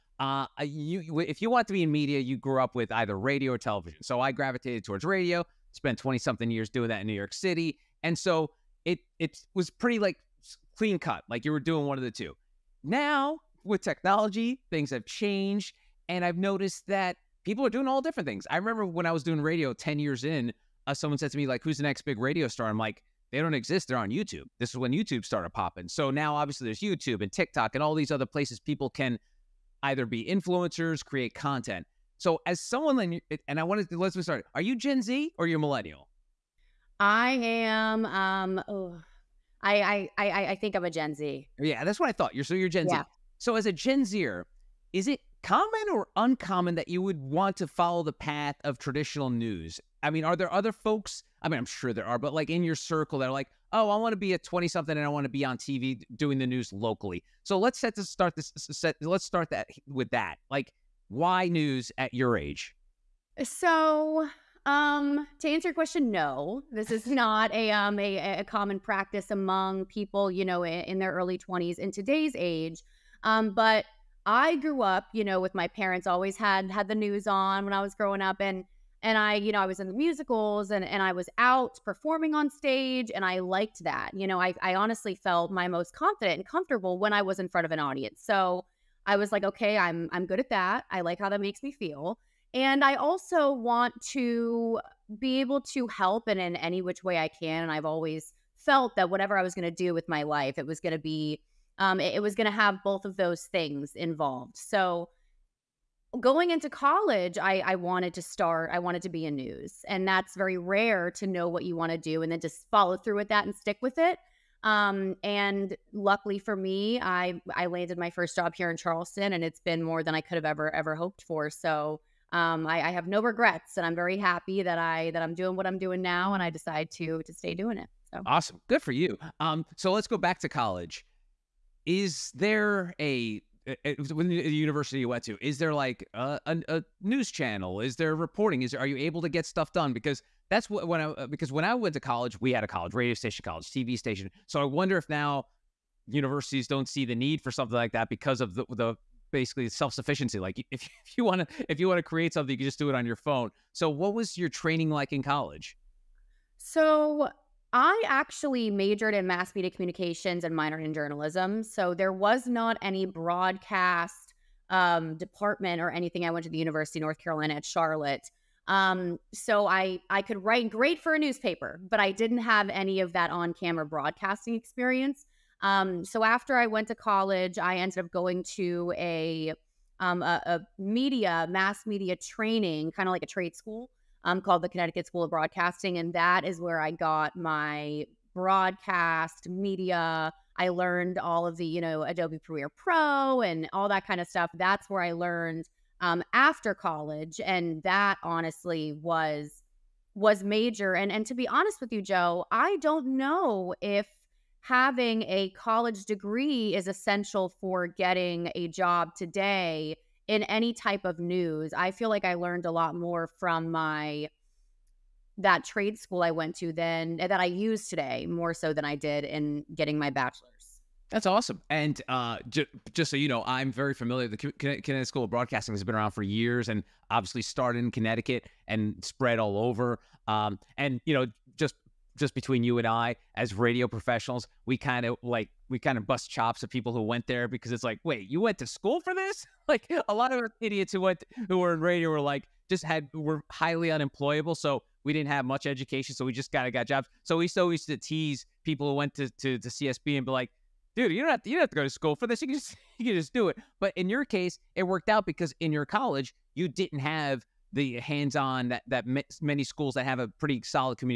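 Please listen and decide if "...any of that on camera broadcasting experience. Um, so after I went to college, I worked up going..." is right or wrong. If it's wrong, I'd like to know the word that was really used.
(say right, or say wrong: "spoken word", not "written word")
wrong: "ended", not "worked".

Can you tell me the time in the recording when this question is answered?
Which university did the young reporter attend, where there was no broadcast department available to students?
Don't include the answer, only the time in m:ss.
2:46.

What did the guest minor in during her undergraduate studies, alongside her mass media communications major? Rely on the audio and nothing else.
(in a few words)
Journalism.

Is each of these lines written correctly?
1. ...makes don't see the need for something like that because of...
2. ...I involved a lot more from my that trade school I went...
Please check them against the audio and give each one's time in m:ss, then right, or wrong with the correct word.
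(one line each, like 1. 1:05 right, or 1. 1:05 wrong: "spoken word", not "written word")
1. 2:26 wrong: "universities", not "makes"
2. 3:32 wrong: "learned", not "involved".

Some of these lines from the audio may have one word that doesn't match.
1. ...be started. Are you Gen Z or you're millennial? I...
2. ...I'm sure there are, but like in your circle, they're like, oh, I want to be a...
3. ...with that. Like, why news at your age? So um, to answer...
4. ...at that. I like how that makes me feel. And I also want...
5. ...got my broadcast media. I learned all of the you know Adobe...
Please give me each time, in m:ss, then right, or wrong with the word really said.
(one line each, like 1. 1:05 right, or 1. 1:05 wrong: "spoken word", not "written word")
1. 0:34 right
2. 0:51 right
3. 0:59 right
4. 1:30 right
5. 3:06 right.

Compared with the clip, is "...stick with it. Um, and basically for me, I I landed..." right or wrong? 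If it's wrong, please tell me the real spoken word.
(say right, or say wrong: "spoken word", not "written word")
wrong: "luckily", not "basically".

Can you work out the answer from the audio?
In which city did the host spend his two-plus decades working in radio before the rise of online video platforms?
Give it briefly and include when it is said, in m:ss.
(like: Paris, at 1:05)
New York City, at 0:07.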